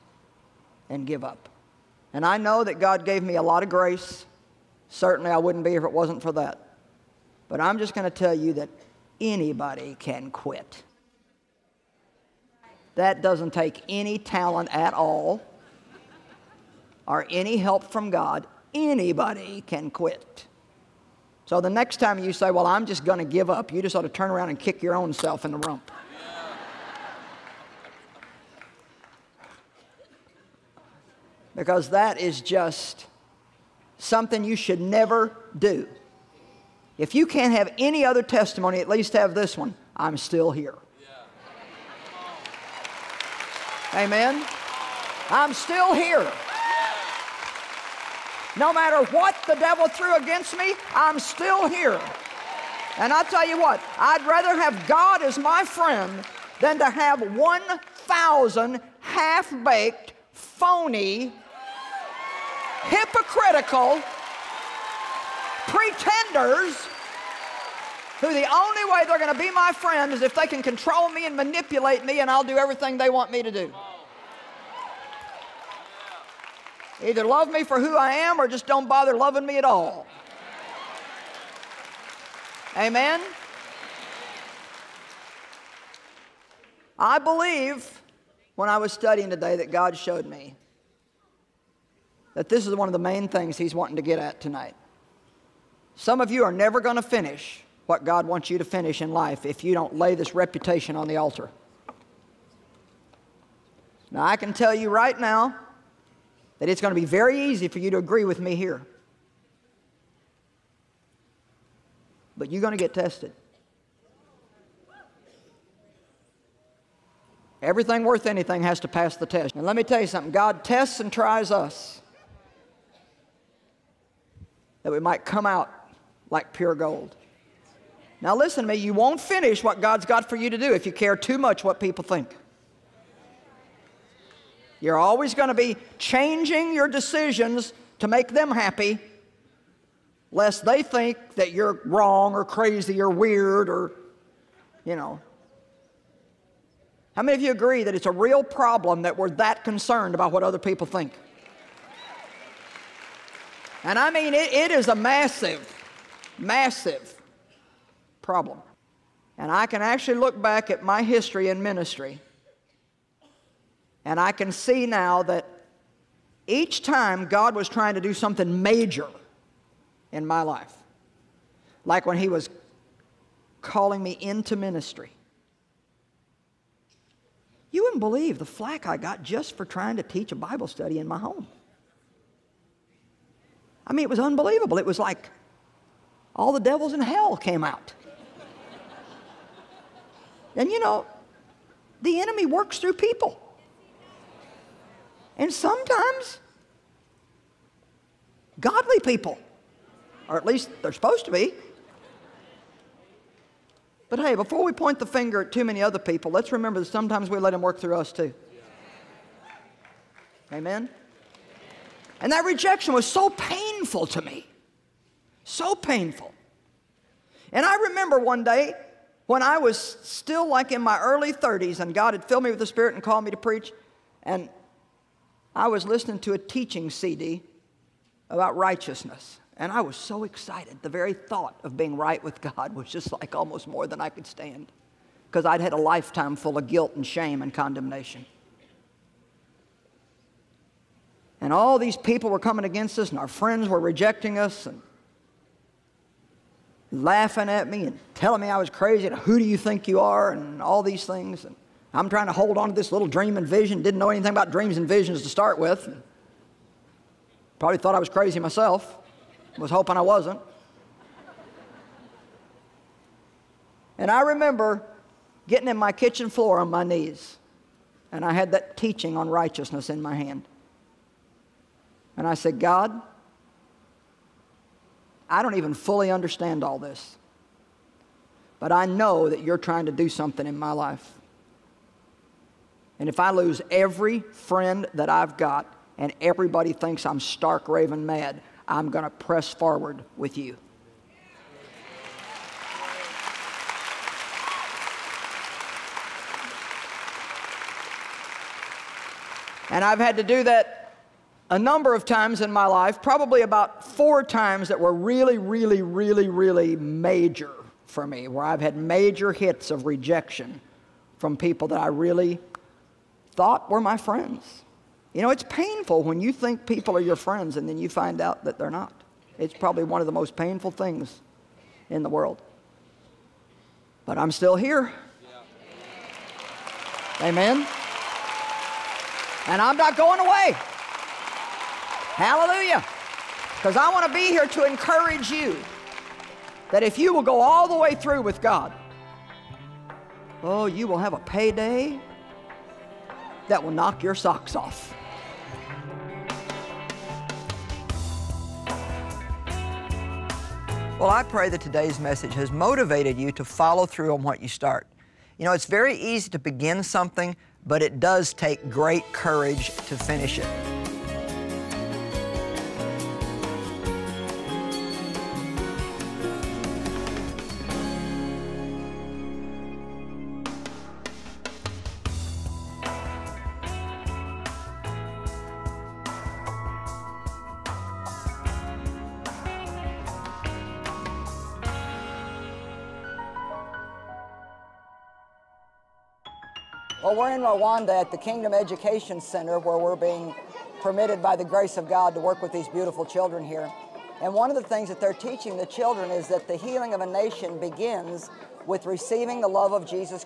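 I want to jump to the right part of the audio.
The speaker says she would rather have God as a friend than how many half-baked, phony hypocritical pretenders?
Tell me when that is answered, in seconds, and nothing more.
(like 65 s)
57 s.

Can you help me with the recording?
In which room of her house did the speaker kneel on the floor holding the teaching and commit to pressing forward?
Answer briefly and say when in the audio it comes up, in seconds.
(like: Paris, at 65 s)
kitchen, at 265 s.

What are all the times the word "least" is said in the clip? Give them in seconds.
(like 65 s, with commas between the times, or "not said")
38 s, 200 s.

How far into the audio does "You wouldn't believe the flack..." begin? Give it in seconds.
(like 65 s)
177 s.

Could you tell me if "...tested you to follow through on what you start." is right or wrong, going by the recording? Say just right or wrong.
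wrong.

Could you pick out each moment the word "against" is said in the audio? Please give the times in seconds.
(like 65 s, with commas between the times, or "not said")
50 s, 242 s.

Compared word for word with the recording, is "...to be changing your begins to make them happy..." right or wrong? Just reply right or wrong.
wrong.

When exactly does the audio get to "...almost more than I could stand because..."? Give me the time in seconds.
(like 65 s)
233 s.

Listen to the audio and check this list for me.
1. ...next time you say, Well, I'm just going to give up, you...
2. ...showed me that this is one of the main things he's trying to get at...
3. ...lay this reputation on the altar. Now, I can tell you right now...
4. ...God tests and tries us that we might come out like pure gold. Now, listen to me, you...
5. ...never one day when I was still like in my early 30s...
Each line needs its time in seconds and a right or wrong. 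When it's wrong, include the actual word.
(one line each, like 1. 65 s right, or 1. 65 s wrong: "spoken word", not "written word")
1. 21 s right
2. 89 s wrong: "wanting", not "trying"
3. 99 s right
4. 120 s right
5. 217 s wrong: "remember", not "never".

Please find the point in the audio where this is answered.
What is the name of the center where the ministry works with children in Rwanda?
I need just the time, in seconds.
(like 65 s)
388 s.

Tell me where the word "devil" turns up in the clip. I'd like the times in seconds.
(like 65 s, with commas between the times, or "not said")
49 s, 186 s.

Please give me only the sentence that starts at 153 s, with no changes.
And I mean, it, it is a massive, massive problem.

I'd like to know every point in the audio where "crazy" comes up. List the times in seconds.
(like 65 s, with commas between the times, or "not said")
142 s, 248 s, 258 s.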